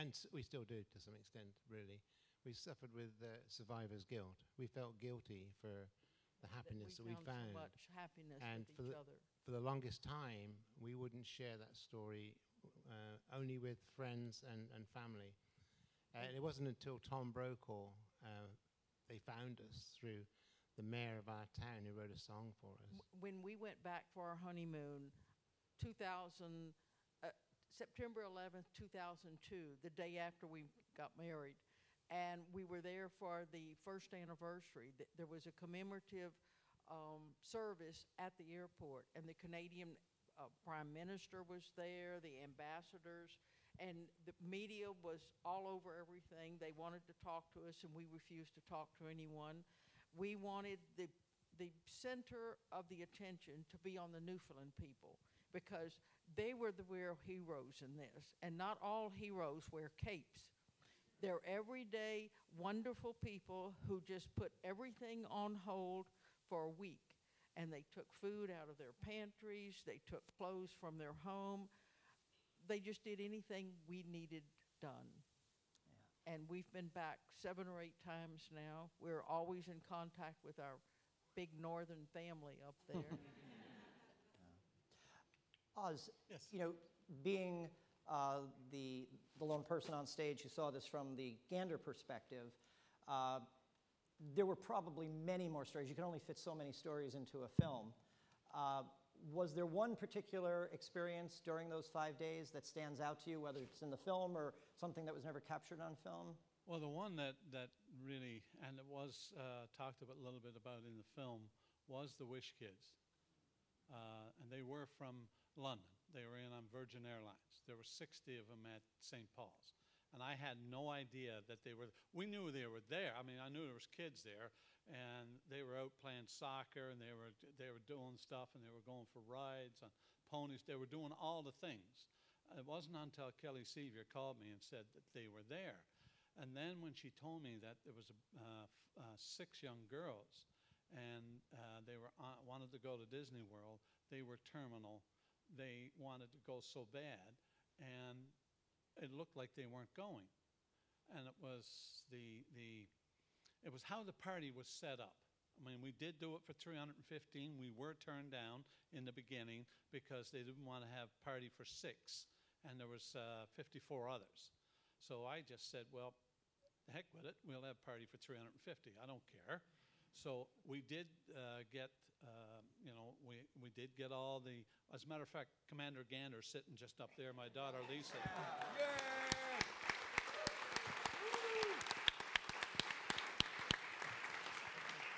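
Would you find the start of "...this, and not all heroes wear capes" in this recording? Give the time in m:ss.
0:57.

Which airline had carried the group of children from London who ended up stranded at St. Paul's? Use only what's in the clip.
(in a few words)
Virgin Airlines.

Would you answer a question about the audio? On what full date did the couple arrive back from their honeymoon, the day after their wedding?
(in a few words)
September 11, 2002.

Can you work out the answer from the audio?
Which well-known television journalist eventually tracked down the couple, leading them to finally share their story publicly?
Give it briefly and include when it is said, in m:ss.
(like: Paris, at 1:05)
Tom Brokaw, at 0:17.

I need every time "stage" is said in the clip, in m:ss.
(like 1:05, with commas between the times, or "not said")
1:30.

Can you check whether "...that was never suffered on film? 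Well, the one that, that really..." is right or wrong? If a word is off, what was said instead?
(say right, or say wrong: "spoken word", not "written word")
wrong: "captured", not "suffered".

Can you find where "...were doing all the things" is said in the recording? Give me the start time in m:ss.
2:10.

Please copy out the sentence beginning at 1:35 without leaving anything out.
You can only fit so many stories into a film.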